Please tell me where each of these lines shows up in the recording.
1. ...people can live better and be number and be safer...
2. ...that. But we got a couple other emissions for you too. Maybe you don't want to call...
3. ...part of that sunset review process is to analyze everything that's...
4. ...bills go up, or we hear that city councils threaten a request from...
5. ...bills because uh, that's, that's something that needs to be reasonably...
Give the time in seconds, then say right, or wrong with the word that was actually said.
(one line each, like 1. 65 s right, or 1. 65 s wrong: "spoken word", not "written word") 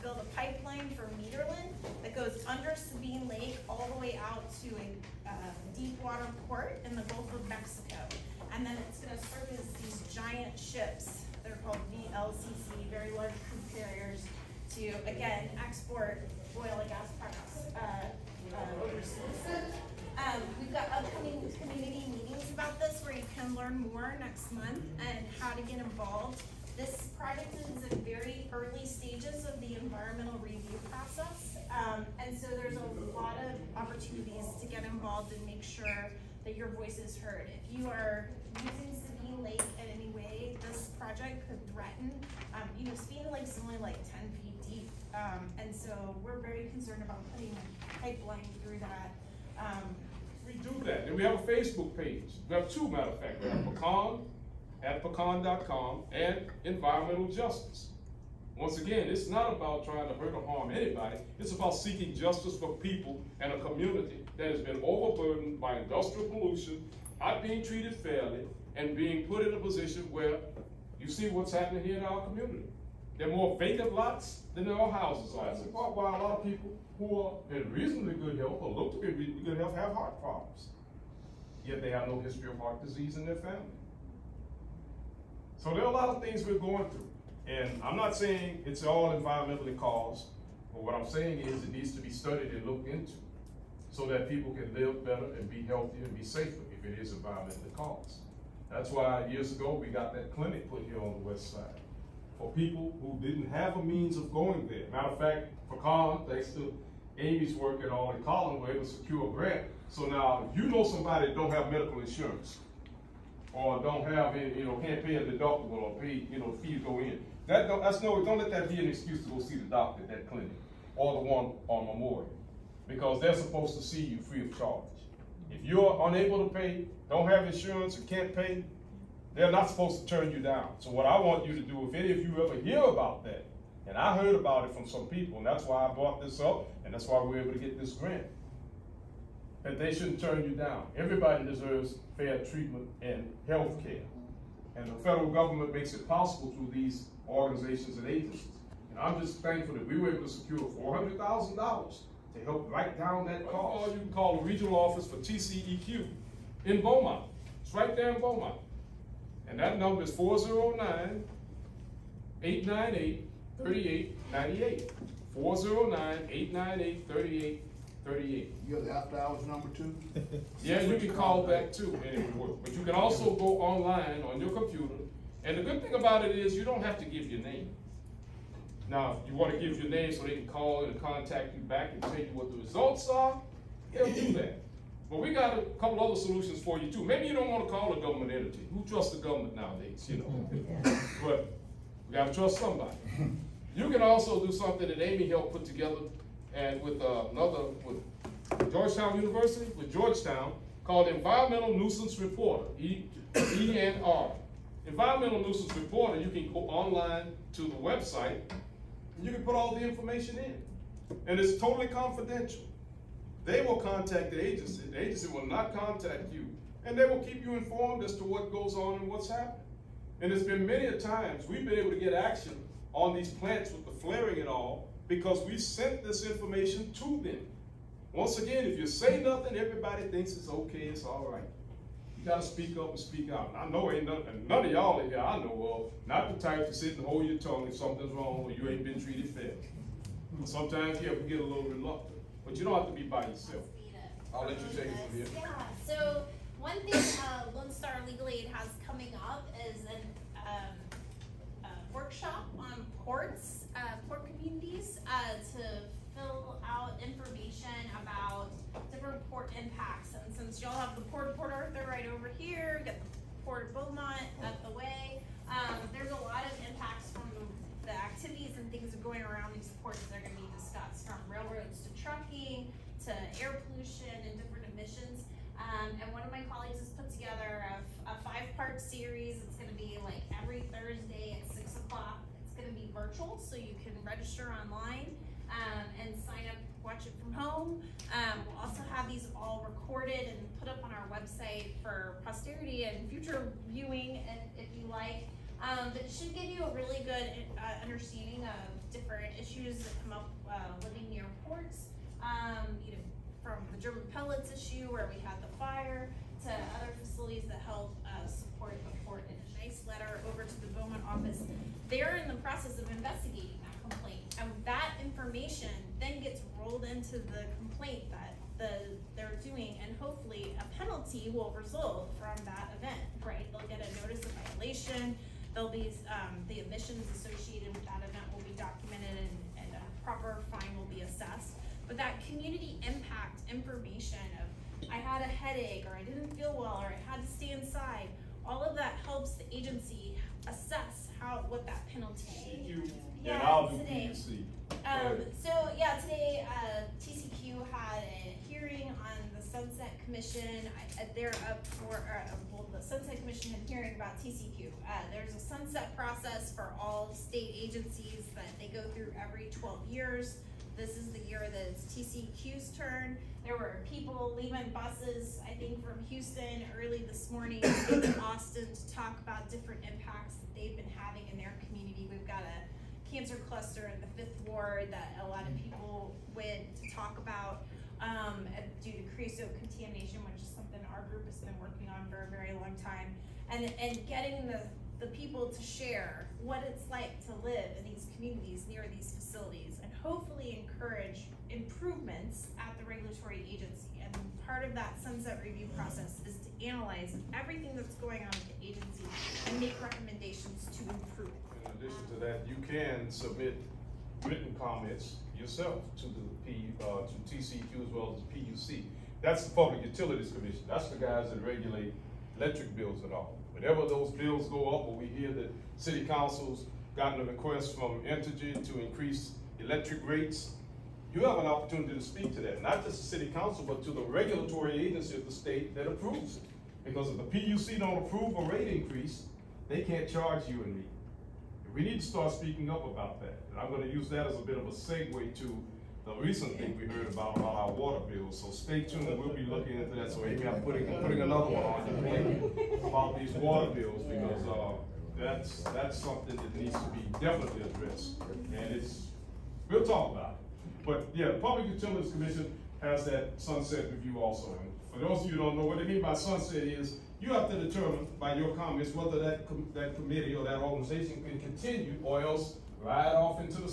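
1. 94 s wrong: "healthier", not "number"
2. 184 s wrong: "solutions", not "emissions"
3. 394 s right
4. 414 s wrong: "gotten", not "threaten"
5. 443 s wrong: "definitely", not "reasonably".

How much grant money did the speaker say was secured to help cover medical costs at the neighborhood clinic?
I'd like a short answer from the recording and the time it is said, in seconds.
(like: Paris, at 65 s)
$400,000, at 150 s.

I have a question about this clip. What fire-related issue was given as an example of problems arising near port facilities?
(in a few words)
German pellets.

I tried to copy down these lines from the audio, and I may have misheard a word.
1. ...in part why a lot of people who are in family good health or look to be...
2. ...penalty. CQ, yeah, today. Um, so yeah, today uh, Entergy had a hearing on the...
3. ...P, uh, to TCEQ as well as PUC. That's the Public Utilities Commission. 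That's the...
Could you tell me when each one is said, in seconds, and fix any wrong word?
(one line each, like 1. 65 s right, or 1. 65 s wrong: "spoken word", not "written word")
1. 75 s wrong: "reasonably", not "family"
2. 341 s wrong: "TCEQ", not "Entergy"
3. 406 s right.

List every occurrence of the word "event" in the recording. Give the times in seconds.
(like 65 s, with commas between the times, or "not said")
322 s, 327 s.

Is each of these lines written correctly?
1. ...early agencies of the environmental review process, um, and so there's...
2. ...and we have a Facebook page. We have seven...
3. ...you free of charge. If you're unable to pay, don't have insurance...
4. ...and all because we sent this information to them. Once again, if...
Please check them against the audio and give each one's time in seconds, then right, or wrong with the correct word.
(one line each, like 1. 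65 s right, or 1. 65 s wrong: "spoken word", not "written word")
1. 28 s wrong: "stages", not "agencies"
2. 51 s wrong: "two", not "seven"
3. 124 s right
4. 224 s right.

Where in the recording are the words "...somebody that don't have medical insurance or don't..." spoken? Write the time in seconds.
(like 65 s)
110 s.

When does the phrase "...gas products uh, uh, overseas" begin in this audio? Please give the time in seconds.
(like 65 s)
16 s.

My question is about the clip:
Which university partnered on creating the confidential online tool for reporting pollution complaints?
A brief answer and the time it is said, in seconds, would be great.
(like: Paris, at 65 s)
Georgetown University, at 198 s.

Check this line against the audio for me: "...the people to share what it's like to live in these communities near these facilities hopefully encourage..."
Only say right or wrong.
right.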